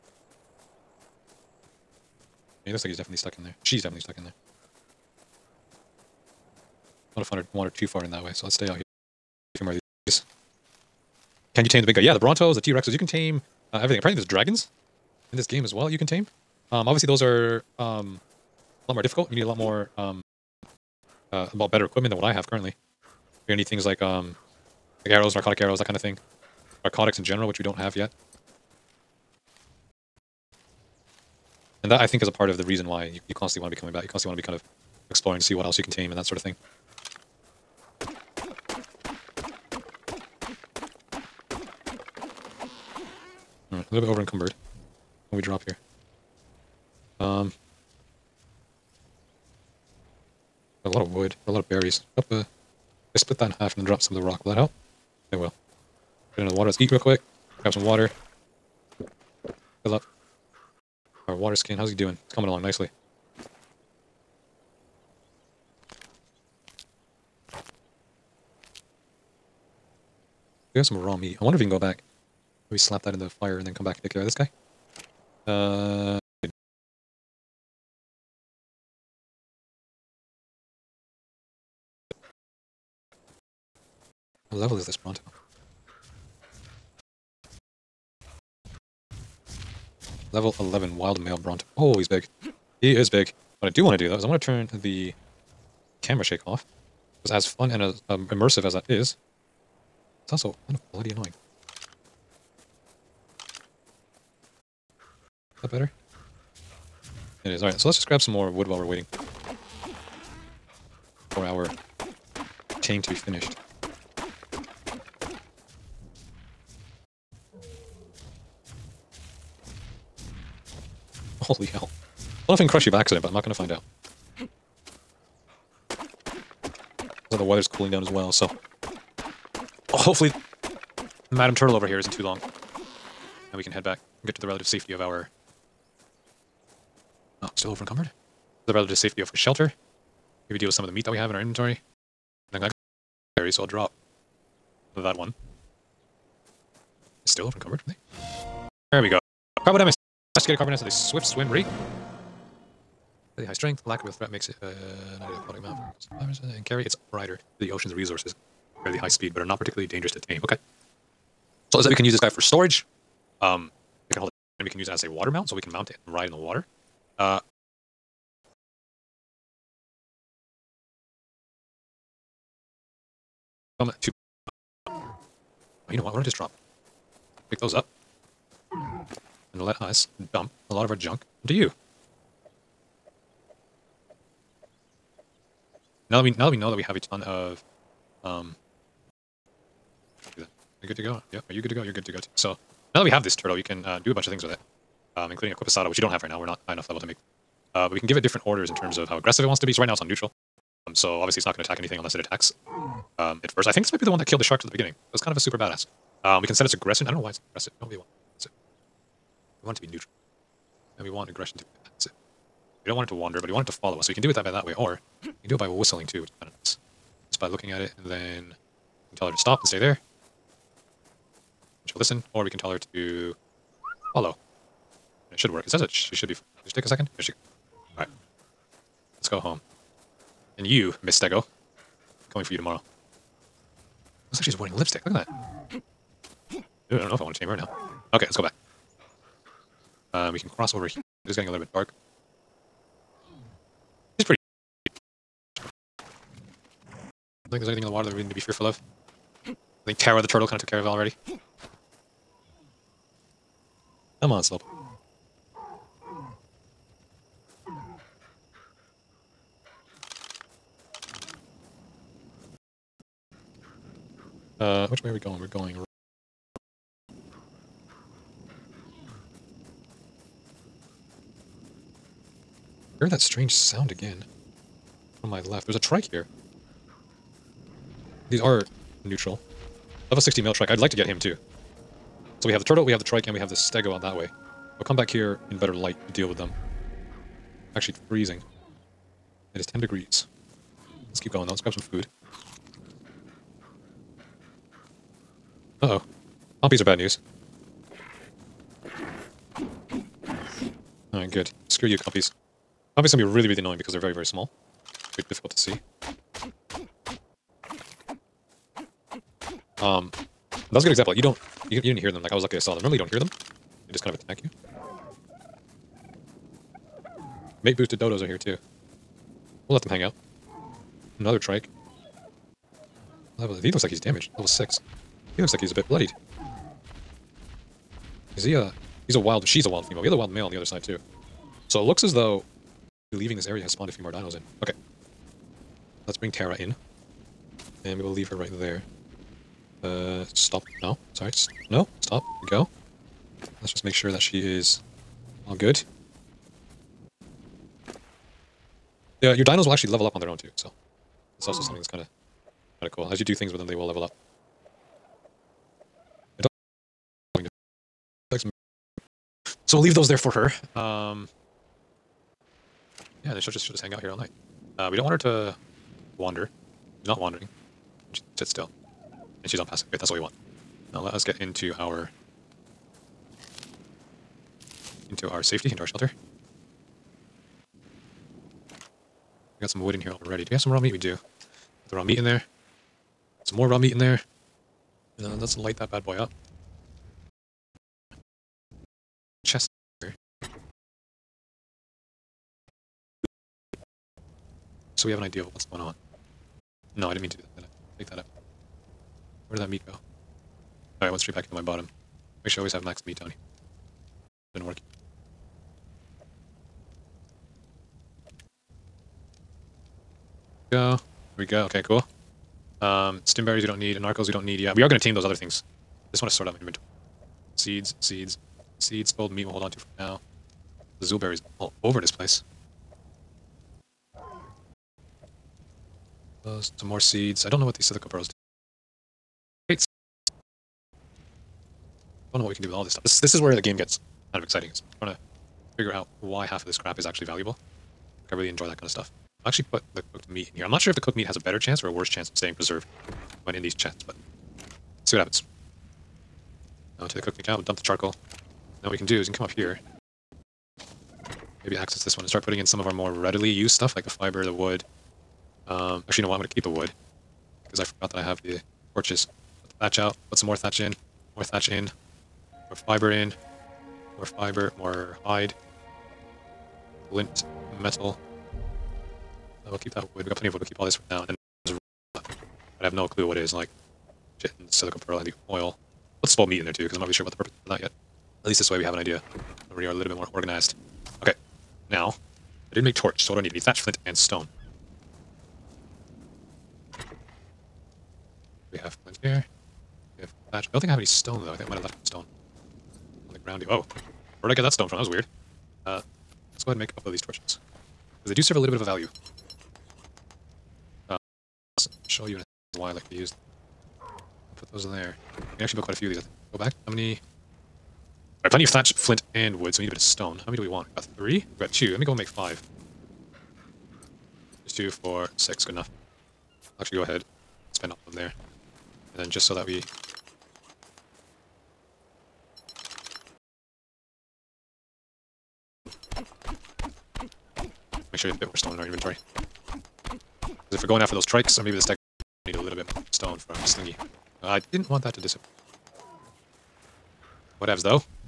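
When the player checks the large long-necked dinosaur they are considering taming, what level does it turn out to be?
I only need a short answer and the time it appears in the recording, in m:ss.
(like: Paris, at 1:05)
11, at 1:30.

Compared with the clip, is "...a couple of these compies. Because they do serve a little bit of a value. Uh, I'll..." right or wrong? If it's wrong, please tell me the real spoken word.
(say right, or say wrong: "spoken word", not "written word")
wrong: "torches", not "compies".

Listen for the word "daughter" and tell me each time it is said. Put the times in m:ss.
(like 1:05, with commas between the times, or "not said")
not said.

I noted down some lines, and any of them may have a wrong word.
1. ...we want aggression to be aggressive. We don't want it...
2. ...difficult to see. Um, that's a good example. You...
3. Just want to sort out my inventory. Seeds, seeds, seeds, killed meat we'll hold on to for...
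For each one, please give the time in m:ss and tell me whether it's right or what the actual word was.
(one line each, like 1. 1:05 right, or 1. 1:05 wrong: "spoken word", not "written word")
1. 3:31 wrong: "passive", not "aggressive"
2. 5:05 right
3. 6:56 wrong: "spoiled", not "killed".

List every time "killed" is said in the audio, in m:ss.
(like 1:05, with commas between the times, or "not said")
3:24.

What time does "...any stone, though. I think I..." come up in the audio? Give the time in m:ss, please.
8:10.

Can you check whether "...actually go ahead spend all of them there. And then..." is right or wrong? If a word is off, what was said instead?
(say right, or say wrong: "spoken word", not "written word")
right.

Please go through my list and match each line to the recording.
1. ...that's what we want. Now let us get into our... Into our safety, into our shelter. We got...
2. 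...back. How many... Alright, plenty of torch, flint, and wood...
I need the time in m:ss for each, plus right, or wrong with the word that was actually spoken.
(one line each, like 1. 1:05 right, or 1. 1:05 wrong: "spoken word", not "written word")
1. 6:09 right
2. 8:26 wrong: "thatch", not "torch".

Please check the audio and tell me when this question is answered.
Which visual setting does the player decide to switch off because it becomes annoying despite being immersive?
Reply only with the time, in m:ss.
1:36.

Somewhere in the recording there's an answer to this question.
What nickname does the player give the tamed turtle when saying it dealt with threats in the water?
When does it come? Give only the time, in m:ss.
4:09.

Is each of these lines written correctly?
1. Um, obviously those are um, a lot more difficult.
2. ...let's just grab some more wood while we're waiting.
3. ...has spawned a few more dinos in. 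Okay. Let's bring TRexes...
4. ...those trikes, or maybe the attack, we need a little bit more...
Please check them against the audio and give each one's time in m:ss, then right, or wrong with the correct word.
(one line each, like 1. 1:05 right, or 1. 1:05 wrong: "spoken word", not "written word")
1. 0:16 right
2. 1:47 right
3. 5:33 wrong: "Terra", not "TRexes"
4. 8:51 wrong: "stack", not "attack".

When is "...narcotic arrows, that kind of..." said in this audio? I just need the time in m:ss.
0:25.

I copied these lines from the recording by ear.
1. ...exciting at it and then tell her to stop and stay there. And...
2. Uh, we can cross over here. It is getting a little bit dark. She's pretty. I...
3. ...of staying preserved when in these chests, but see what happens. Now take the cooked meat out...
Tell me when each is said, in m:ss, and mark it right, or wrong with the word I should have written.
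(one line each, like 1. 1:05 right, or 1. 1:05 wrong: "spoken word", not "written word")
1. 3:37 wrong: "looking", not "exciting"
2. 4:00 right
3. 7:22 right.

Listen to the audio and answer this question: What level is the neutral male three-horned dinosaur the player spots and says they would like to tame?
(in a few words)
60.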